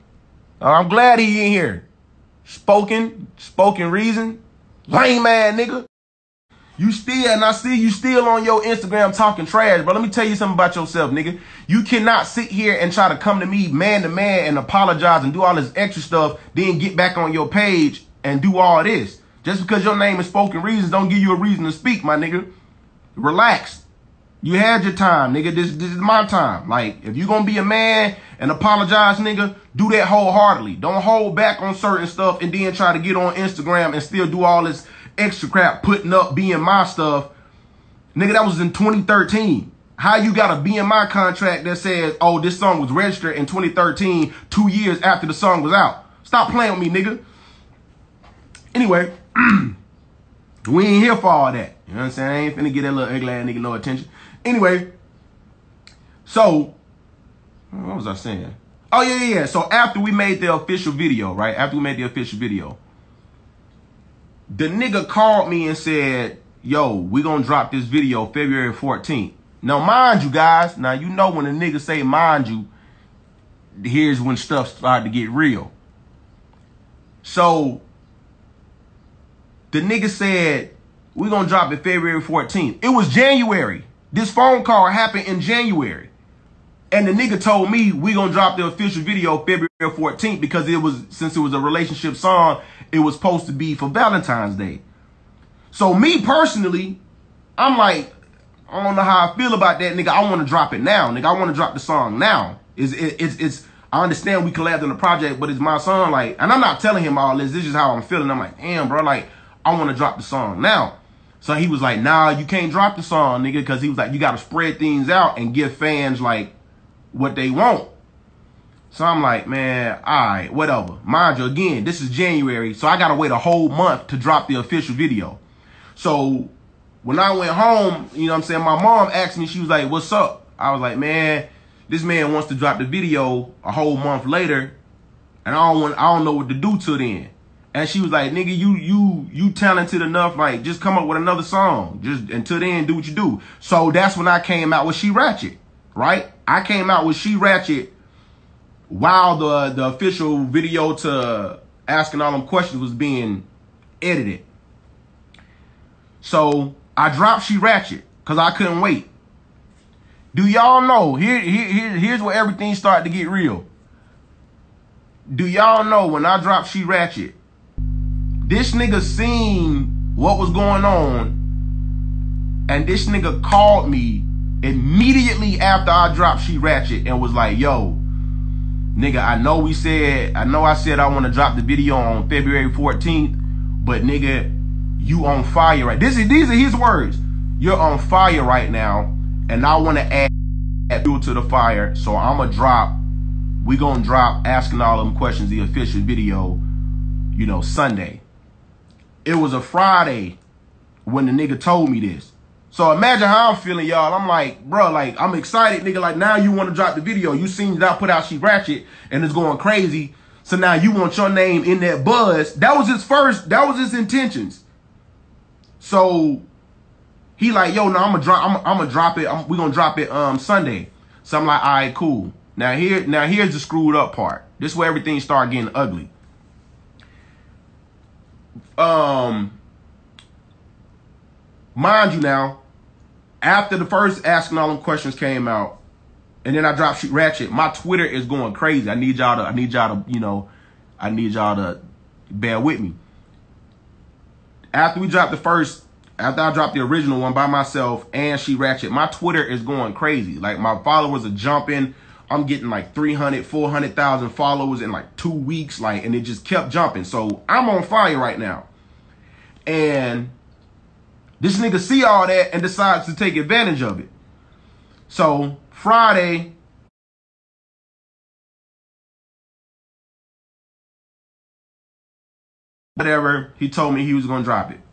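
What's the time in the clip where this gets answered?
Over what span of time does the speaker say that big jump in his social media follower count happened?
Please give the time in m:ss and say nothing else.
4:15.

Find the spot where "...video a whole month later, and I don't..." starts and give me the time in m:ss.
2:12.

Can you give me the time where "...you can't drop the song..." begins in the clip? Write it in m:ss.
1:52.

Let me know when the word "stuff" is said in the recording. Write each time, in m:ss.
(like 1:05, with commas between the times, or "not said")
0:16, 0:32, 0:36, 1:14.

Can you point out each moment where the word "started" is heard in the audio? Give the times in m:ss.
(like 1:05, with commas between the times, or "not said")
1:14, 2:42, 3:45.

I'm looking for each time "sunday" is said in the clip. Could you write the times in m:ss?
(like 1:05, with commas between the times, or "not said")
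3:17, 3:40.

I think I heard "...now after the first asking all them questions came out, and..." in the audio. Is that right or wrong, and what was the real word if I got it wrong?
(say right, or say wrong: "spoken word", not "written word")
right.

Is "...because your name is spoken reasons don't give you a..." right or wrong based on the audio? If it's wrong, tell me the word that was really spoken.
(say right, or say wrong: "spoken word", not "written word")
right.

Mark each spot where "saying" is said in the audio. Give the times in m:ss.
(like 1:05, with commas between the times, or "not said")
0:52, 0:58, 2:08.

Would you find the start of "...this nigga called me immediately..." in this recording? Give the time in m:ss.
2:52.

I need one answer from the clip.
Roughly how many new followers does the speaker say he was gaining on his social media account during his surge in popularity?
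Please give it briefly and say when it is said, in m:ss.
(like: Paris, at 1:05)
300,000 to 400,000, at 4:12.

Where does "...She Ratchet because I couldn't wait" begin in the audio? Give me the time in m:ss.
2:37.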